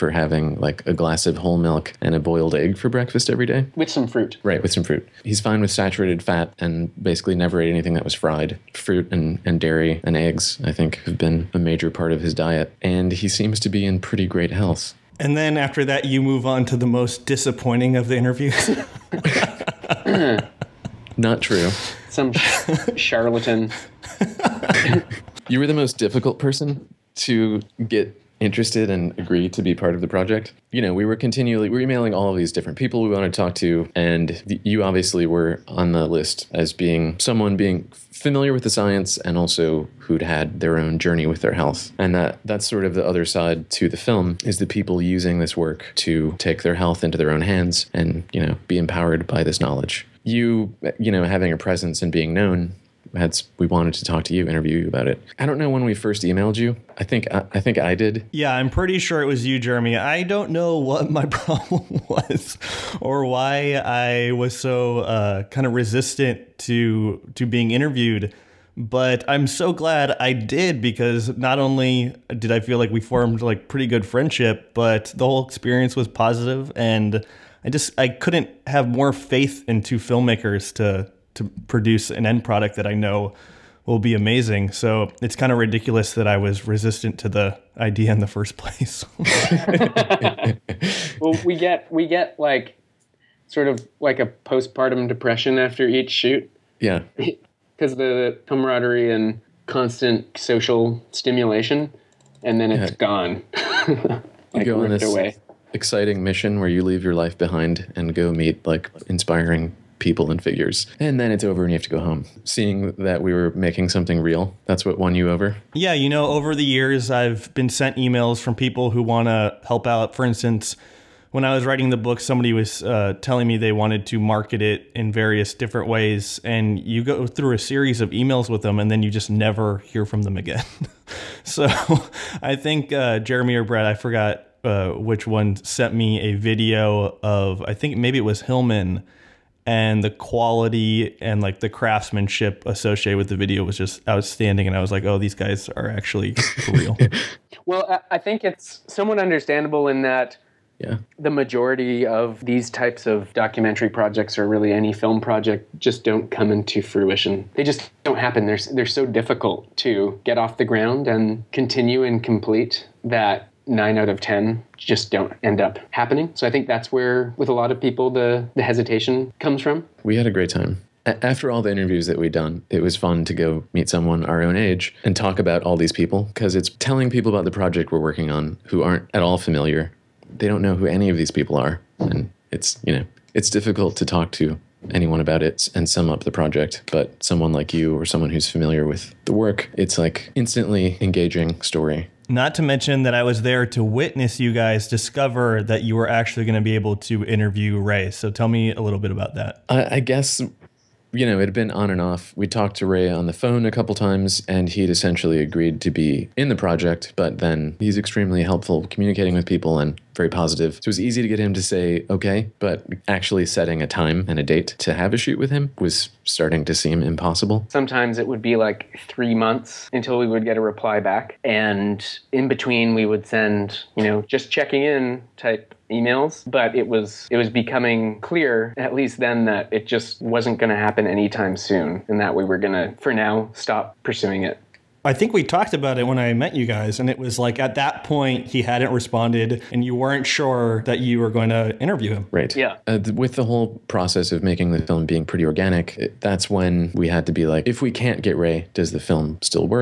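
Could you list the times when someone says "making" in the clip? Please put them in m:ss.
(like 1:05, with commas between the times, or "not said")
1:53, 4:04.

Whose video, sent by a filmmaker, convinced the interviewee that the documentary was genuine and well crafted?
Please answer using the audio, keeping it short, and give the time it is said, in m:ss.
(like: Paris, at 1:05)
Hillman, at 2:18.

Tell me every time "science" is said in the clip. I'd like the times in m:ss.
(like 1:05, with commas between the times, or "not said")
0:38.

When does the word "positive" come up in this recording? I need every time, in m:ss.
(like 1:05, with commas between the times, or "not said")
1:16, 3:30.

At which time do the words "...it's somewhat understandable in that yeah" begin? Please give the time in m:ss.
2:28.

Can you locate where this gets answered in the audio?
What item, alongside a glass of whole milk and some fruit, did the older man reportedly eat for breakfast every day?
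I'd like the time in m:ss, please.
0:02.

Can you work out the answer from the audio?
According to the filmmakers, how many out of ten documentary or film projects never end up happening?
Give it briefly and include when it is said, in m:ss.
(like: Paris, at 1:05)
9, at 2:43.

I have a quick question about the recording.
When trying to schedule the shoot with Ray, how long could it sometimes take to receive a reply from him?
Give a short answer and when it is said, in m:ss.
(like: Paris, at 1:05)
3 months, at 3:39.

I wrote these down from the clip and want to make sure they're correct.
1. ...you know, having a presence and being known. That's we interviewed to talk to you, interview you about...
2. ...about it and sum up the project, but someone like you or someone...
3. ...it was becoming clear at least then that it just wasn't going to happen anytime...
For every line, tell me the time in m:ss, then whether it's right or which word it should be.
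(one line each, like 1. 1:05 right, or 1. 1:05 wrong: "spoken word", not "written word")
1. 0:50 wrong: "wanted", not "interviewed"
2. 3:05 right
3. 3:47 right.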